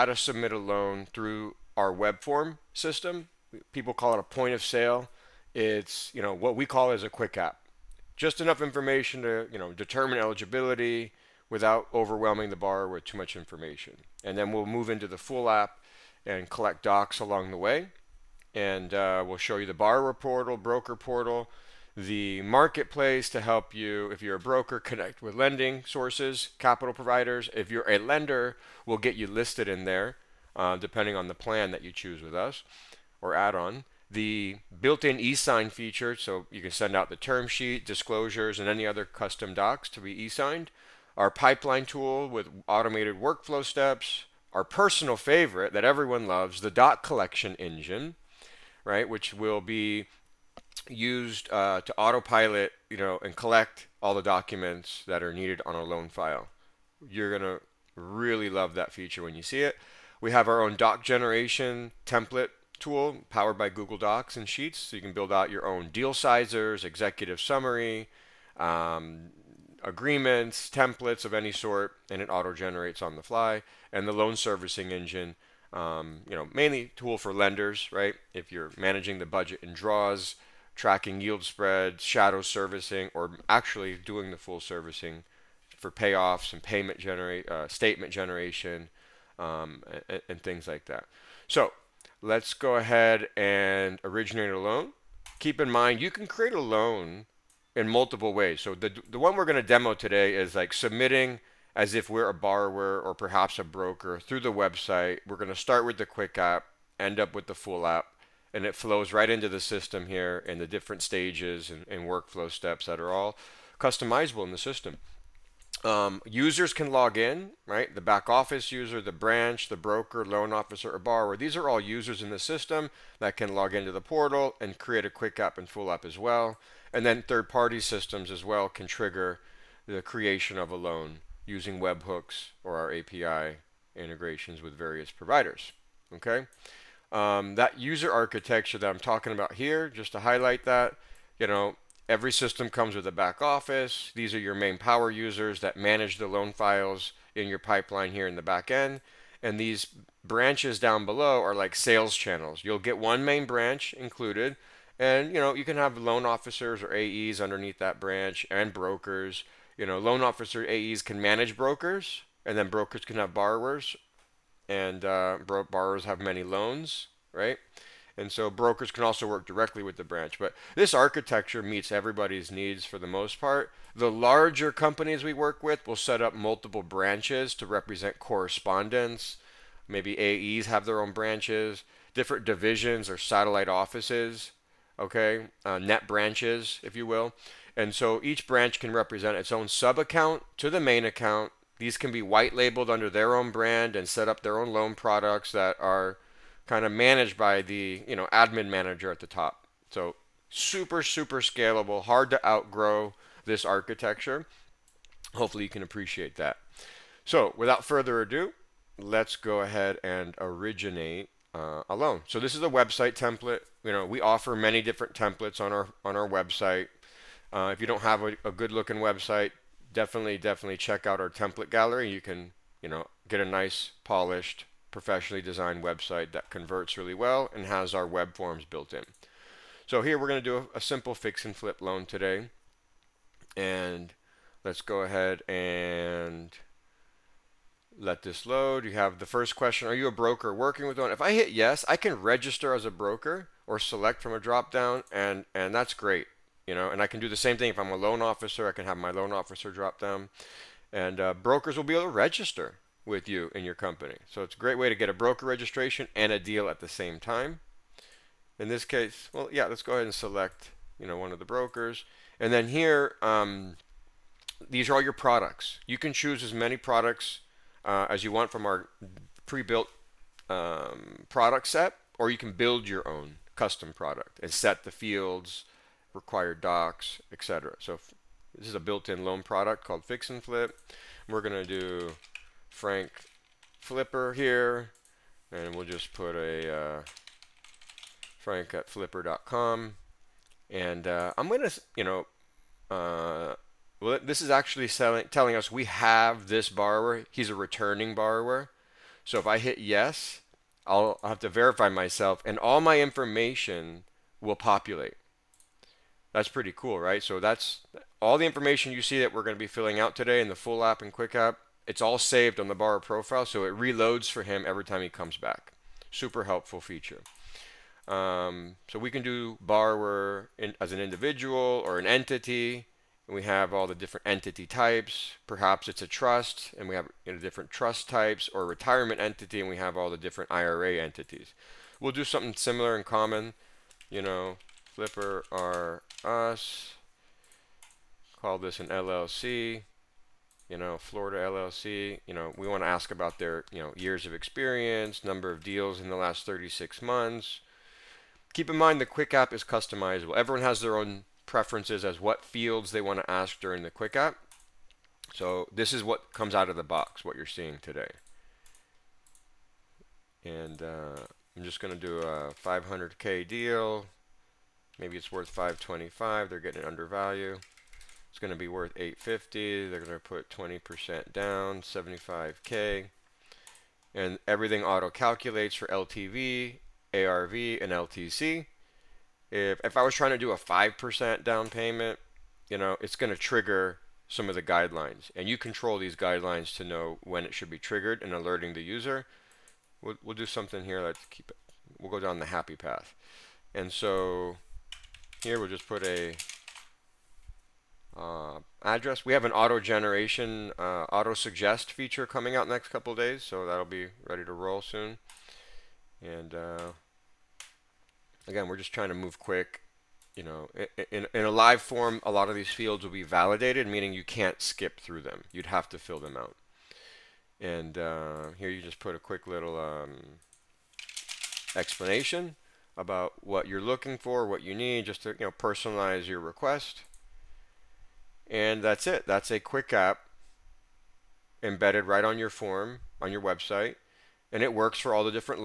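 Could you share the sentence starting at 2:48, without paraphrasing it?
And so brokers can also work directly with the branch.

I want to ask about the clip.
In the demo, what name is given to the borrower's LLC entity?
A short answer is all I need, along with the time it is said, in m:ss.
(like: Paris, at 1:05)
Flipper are us, at 5:34.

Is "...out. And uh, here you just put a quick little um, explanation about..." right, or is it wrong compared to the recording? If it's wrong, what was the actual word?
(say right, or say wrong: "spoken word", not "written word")
right.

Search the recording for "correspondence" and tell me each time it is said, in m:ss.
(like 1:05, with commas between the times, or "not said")
2:58.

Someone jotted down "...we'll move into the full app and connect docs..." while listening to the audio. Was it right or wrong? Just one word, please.
wrong.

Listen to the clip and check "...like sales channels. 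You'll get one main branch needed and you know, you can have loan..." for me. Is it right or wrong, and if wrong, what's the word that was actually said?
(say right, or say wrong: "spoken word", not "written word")
wrong: "included", not "needed".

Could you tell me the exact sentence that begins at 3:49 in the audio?
So here we're going to do a, a, simple fix and flip loan today.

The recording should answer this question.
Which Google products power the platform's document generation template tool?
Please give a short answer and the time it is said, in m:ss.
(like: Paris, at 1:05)
Google Docs and Sheets, at 1:03.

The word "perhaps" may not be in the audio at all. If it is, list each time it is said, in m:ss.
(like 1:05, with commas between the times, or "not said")
1:43, 5:25.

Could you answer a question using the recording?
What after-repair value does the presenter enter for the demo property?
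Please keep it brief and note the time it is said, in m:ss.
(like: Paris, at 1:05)
850, at 6:08.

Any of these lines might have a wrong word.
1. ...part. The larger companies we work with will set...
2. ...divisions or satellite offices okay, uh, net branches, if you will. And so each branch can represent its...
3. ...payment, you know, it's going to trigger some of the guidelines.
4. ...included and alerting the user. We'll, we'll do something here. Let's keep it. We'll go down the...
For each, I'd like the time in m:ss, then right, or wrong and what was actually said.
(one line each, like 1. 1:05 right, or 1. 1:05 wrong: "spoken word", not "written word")
1. 2:53 right
2. 3:02 right
3. 6:21 right
4. 6:27 wrong: "triggered", not "included".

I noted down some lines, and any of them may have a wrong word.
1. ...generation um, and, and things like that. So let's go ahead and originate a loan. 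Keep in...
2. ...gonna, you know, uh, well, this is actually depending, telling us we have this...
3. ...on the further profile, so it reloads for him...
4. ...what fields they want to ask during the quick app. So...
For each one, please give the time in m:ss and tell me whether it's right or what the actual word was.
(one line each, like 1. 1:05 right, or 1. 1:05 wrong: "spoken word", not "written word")
1. 1:28 right
2. 4:51 wrong: "selling", not "depending"
3. 5:12 wrong: "borrower", not "further"
4. 5:52 right.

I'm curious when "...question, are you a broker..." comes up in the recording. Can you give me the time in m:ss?
3:59.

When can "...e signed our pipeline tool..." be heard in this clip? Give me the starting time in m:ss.
0:40.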